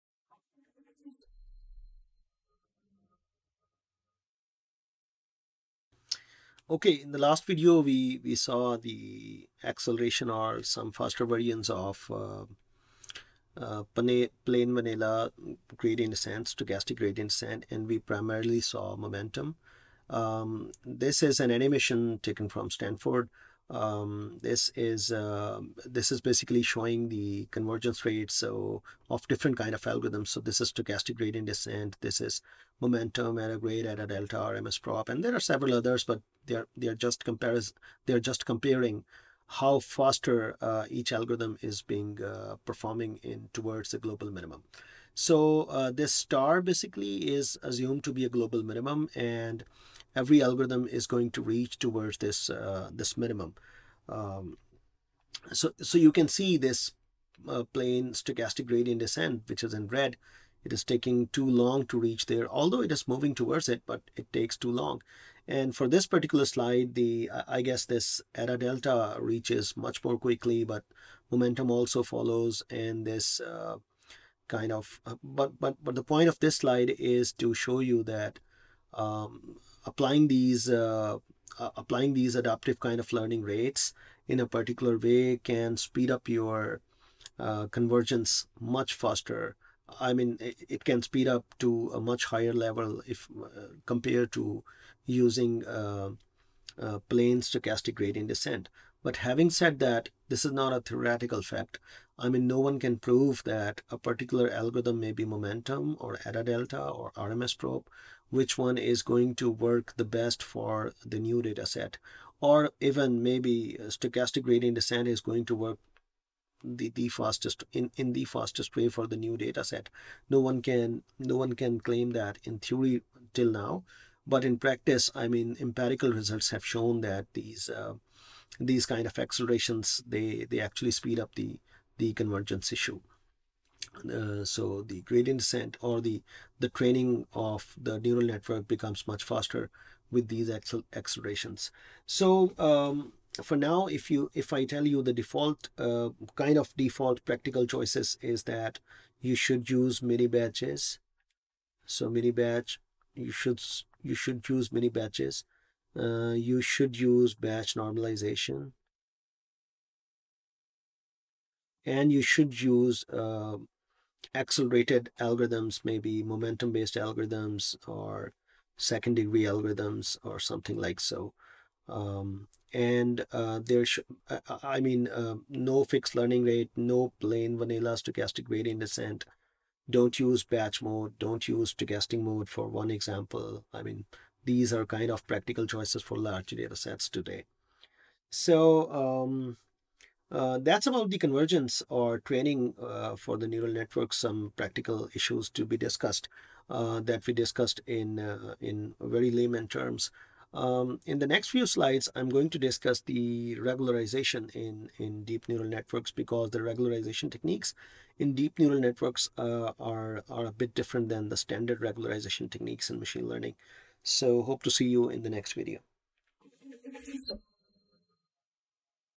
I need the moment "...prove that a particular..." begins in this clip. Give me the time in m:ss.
1:42.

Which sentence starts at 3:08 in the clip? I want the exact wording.
So um, uh, that's about the convergence or training uh, for the neural network.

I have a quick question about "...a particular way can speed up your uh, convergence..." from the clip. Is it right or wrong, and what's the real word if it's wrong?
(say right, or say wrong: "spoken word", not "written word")
right.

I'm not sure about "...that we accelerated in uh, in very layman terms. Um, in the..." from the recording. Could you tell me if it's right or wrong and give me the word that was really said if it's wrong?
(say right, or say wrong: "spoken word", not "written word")
wrong: "discussed", not "accelerated".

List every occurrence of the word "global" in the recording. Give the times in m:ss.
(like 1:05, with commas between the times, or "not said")
0:43, 0:48.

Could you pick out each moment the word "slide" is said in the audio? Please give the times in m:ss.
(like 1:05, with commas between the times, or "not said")
1:06, 1:16, 3:21.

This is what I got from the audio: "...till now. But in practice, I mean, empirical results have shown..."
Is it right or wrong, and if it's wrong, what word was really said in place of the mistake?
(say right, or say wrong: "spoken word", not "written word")
right.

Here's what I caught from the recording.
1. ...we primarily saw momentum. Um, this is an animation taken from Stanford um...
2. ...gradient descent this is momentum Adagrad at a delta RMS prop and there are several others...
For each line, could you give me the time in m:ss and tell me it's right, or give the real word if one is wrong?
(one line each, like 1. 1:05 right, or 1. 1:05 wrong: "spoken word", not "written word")
1. 0:17 right
2. 0:31 right.